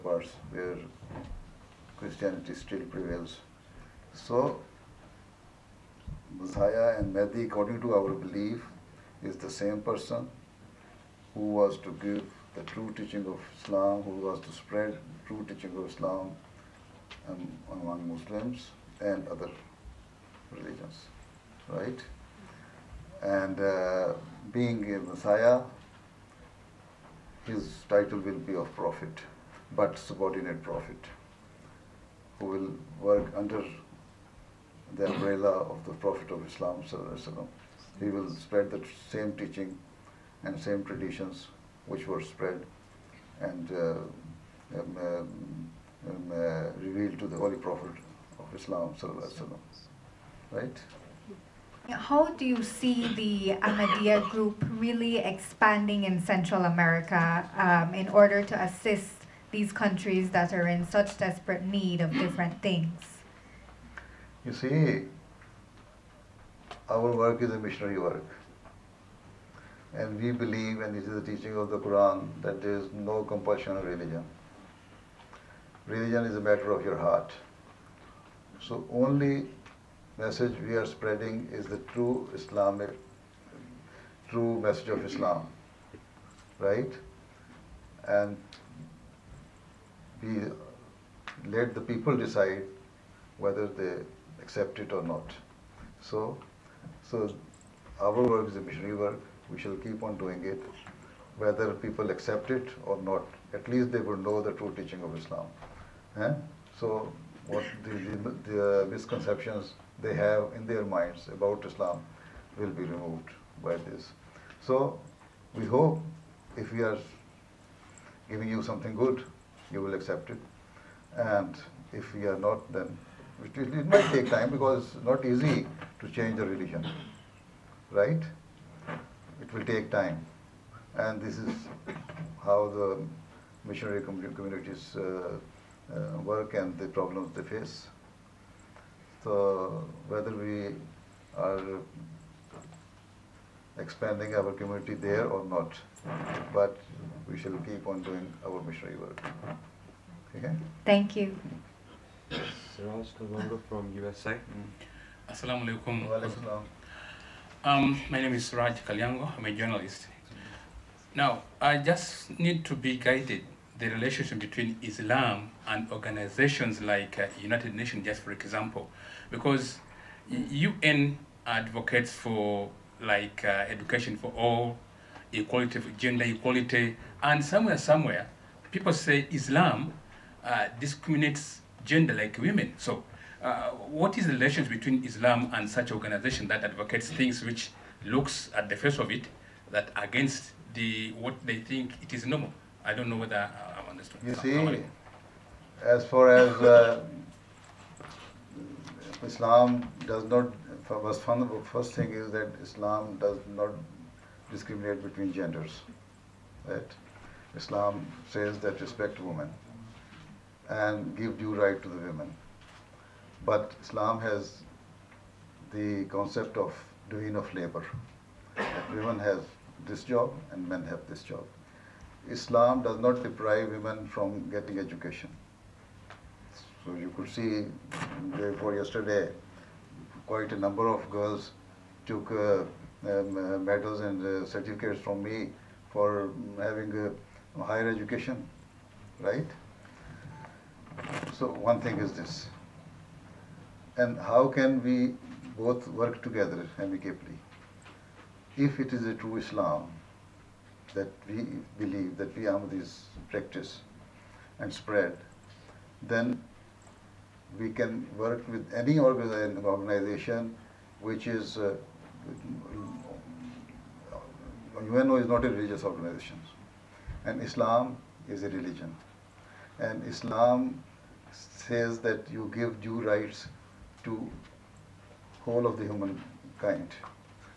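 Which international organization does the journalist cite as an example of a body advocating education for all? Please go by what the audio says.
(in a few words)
United Nations.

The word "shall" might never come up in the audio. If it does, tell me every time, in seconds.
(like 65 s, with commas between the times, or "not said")
99 s, 147 s.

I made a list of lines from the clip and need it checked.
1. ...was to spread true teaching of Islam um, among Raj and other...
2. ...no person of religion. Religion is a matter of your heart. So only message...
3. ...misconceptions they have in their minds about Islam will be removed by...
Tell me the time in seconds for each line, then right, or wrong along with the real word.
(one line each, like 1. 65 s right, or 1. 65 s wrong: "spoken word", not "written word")
1. 14 s wrong: "Muslims", not "Raj"
2. 72 s wrong: "compulsion", not "person"
3. 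108 s right.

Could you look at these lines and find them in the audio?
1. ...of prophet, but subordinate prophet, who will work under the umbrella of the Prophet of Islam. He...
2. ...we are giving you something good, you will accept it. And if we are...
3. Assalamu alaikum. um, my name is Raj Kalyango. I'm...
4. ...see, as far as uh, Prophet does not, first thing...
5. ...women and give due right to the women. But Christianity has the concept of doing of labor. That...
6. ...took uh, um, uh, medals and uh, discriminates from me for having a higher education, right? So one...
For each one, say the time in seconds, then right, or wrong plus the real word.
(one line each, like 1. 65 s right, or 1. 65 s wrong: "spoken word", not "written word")
1. 28 s right
2. 116 s right
3. 155 s right
4. 194 s wrong: "Islam", not "Prophet"
5. 209 s wrong: "Islam", not "Christianity"
6. 232 s wrong: "certificates", not "discriminates".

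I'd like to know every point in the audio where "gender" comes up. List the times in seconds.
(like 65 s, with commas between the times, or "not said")
175 s, 181 s, 205 s.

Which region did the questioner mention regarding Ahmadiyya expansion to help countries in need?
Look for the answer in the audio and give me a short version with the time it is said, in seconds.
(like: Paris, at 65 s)
Central America, at 56 s.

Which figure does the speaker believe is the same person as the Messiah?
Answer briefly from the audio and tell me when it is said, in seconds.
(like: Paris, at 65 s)
Mehdi, at 7 s.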